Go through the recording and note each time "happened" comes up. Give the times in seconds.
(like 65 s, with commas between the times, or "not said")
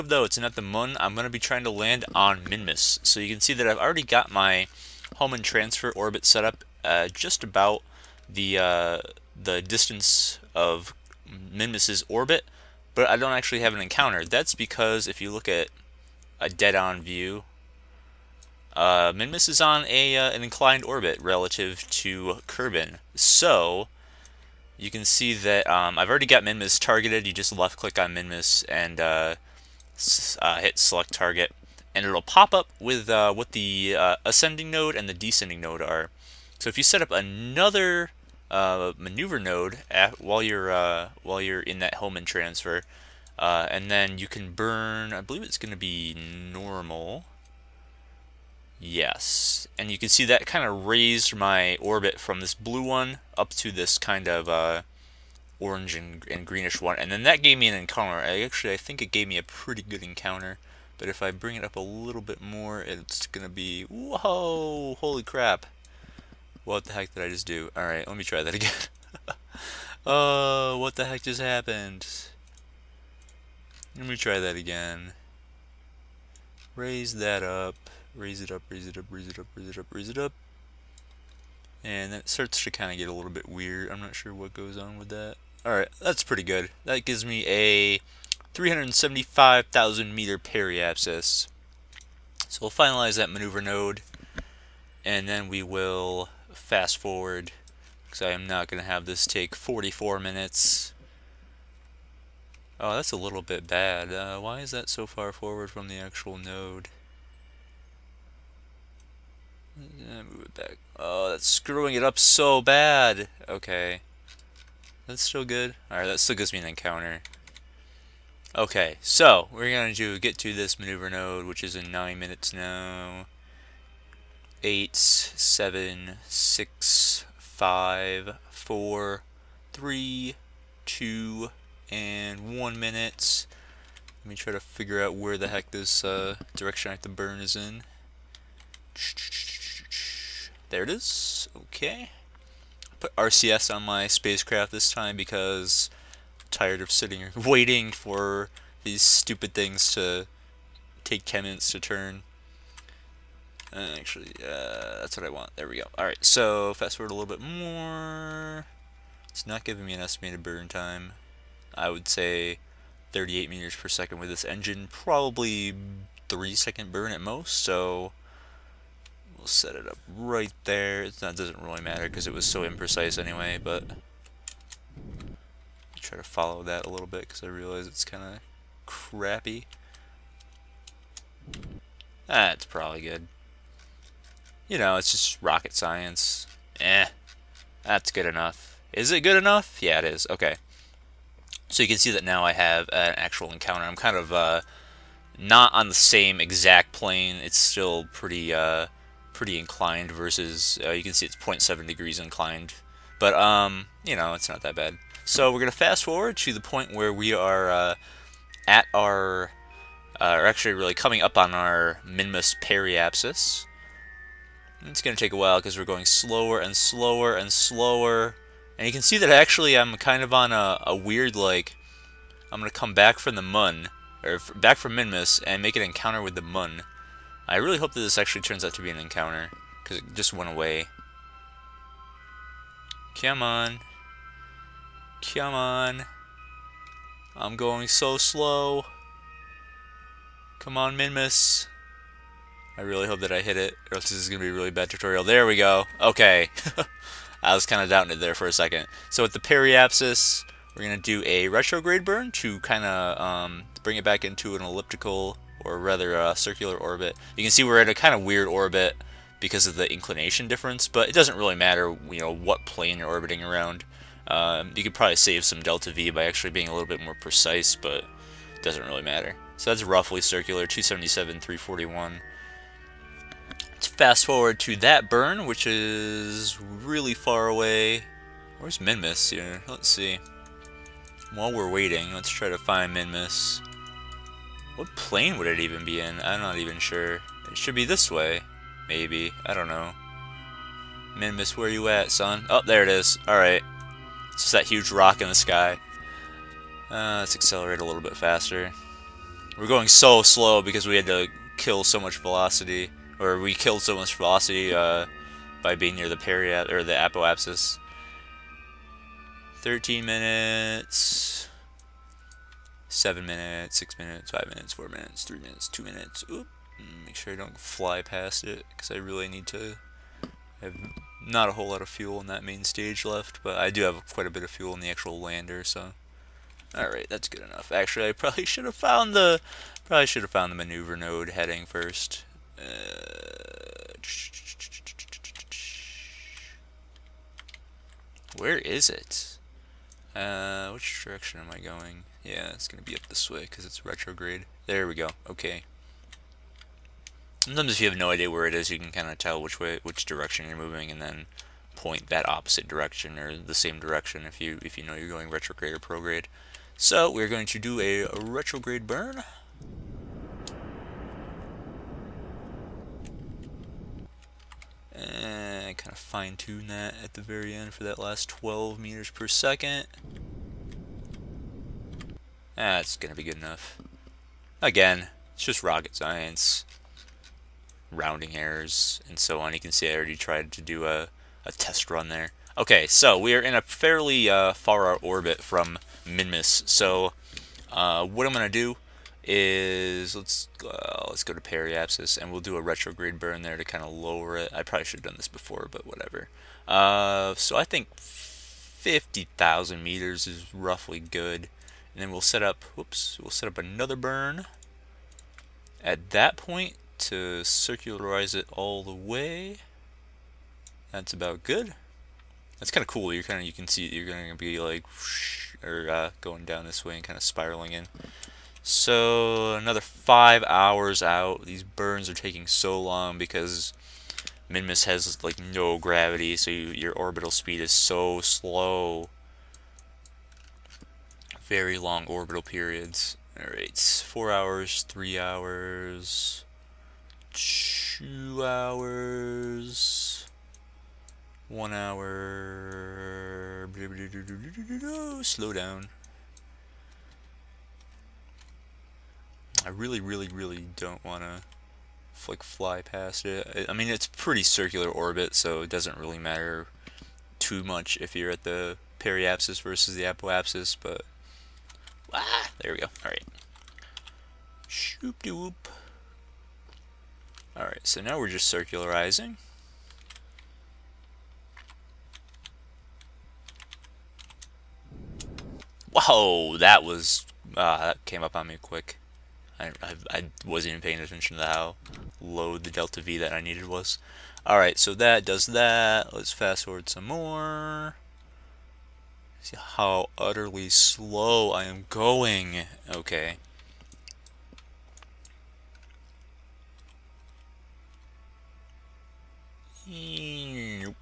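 71 s.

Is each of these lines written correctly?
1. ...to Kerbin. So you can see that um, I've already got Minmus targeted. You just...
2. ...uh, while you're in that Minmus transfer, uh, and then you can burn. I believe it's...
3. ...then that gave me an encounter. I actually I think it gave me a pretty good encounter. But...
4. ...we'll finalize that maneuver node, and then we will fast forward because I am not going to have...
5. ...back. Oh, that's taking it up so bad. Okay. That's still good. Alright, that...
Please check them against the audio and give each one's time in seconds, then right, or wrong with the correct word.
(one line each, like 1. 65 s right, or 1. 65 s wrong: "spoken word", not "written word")
1. 21 s right
2. 40 s wrong: "Hohmann", not "Minmus"
3. 57 s right
4. 92 s right
5. 110 s wrong: "screwing", not "taking".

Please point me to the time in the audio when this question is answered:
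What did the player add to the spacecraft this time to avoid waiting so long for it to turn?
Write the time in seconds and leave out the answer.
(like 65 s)
143 s.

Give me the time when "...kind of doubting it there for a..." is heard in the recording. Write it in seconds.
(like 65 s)
247 s.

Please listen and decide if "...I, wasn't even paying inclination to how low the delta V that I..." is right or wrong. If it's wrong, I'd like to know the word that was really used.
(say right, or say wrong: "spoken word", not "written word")
wrong: "attention", not "inclination".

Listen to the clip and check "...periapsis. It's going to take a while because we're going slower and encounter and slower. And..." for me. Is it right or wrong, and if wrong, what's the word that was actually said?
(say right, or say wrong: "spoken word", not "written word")
wrong: "slower", not "encounter".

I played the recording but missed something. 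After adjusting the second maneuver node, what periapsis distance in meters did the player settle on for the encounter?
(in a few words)
375,000 meters.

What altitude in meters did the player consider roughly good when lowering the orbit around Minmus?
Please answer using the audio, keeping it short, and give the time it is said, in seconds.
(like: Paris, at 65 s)
50,000 meters, at 397 s.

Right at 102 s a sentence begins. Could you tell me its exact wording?
Oh, that's a little bit bad.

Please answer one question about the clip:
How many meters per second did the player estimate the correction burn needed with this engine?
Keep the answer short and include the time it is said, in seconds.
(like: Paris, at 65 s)
38 meters per second, at 163 s.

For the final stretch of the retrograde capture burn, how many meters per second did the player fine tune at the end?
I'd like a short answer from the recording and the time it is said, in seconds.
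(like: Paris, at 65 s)
12, at 368 s.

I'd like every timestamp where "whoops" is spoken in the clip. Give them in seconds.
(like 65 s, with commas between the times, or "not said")
402 s, 465 s.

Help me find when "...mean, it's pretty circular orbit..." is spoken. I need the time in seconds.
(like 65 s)
453 s.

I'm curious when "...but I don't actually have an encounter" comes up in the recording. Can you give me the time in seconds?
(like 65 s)
12 s.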